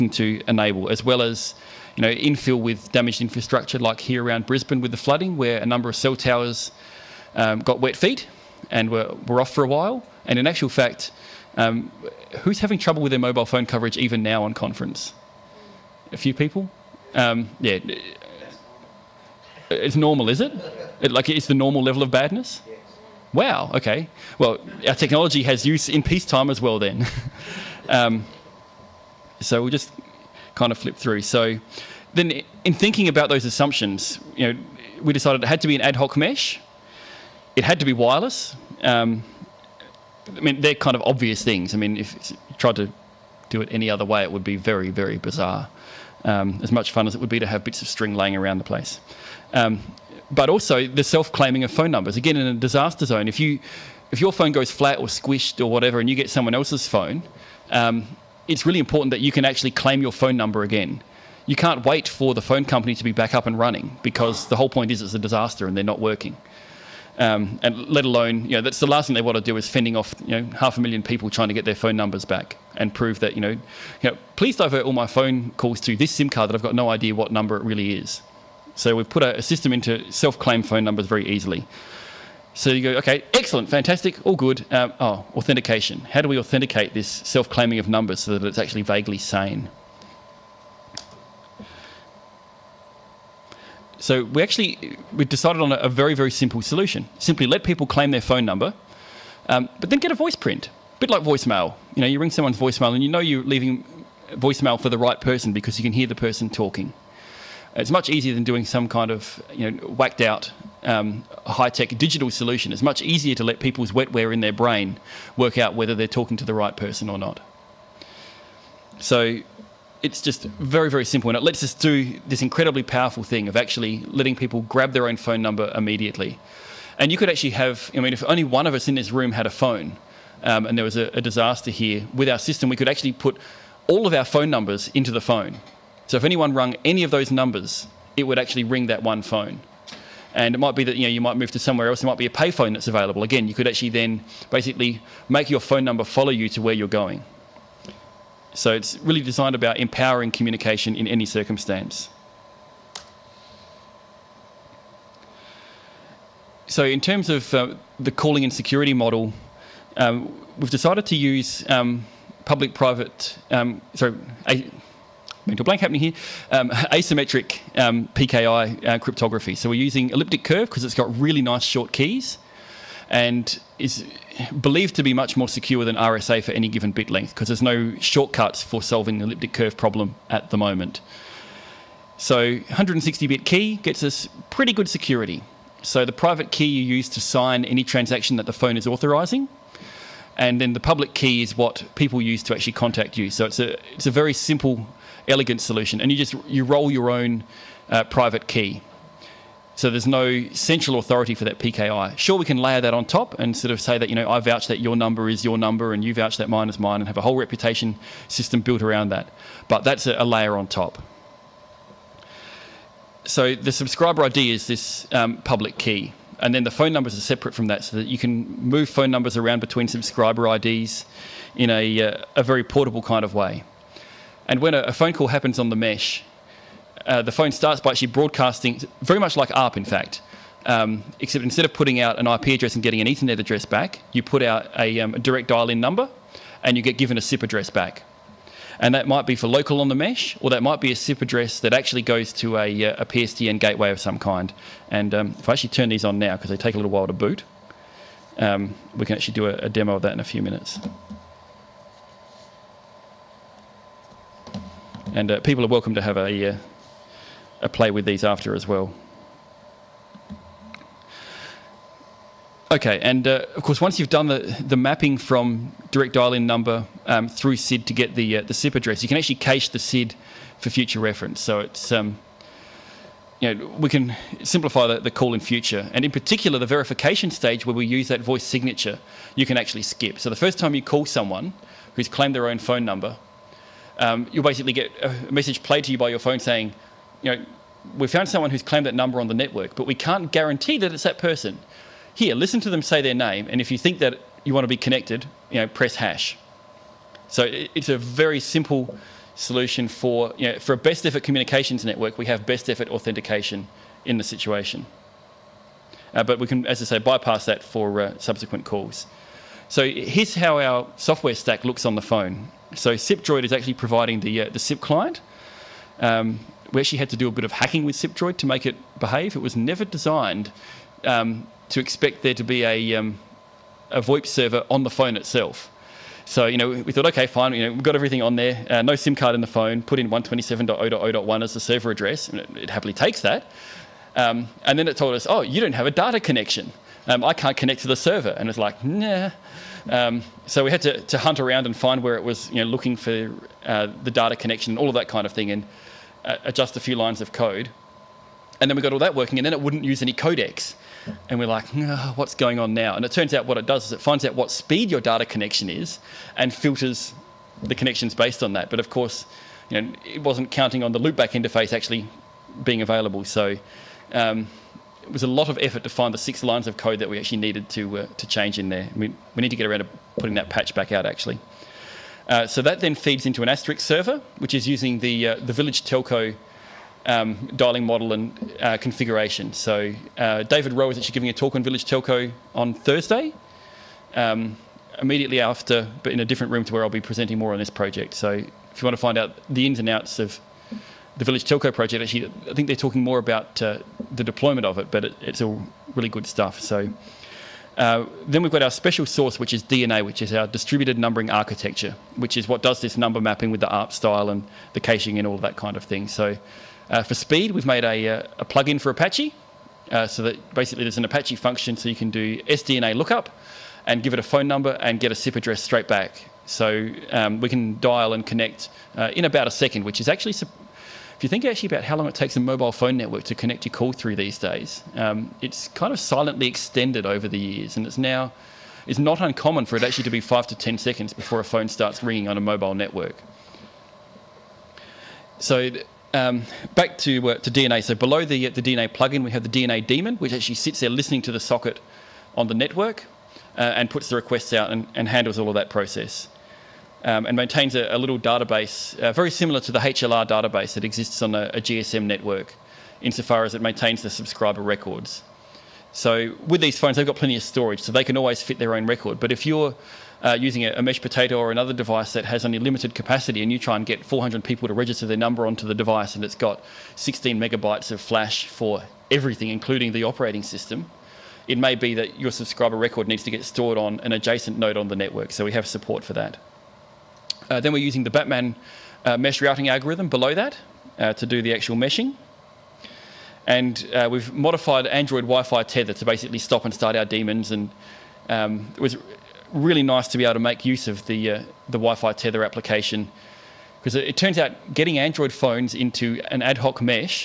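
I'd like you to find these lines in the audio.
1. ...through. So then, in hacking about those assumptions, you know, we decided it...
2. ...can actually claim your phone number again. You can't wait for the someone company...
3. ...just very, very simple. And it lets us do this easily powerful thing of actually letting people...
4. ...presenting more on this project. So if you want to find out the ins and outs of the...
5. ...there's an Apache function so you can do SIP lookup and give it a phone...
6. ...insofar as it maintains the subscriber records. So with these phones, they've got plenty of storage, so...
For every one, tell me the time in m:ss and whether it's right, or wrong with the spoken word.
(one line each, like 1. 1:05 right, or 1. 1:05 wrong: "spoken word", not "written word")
1. 0:30 wrong: "thinking", not "hacking"
2. 0:59 wrong: "phone", not "someone"
3. 2:00 wrong: "incredibly", not "easily"
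4. 6:26 right
5. 6:50 wrong: "SDNA", not "SIP"
6. 7:33 right.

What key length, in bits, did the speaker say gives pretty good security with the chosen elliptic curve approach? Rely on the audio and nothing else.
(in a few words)
160.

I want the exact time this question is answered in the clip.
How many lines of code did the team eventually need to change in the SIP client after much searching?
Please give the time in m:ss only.
6:06.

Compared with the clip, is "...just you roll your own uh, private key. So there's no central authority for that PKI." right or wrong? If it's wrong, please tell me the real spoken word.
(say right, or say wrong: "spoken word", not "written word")
right.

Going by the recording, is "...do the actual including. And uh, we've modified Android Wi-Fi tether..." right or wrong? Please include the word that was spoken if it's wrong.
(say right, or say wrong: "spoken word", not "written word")
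wrong: "meshing", not "including".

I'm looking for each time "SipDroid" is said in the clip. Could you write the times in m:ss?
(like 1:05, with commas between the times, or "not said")
5:12, 5:17.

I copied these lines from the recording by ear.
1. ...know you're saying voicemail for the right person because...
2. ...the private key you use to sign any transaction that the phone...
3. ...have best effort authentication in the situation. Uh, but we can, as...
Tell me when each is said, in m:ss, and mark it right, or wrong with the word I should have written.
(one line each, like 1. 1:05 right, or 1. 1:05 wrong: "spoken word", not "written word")
1. 1:43 wrong: "leaving", not "saying"
2. 3:06 right
3. 5:02 right.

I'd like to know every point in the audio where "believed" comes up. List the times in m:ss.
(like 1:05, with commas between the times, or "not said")
2:54.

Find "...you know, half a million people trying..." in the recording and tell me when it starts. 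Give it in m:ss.
1:10.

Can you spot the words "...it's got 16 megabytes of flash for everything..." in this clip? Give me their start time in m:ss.
7:46.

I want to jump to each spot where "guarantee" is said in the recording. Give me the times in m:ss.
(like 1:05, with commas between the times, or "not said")
4:50.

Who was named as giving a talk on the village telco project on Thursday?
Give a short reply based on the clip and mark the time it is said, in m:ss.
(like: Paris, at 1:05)
David Rowe, at 6:20.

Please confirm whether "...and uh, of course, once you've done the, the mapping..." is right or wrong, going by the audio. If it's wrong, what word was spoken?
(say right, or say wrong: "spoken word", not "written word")
right.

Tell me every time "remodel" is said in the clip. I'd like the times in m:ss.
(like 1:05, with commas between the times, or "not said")
not said.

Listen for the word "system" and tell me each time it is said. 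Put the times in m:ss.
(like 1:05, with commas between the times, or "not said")
1:19, 2:12, 3:28, 7:50.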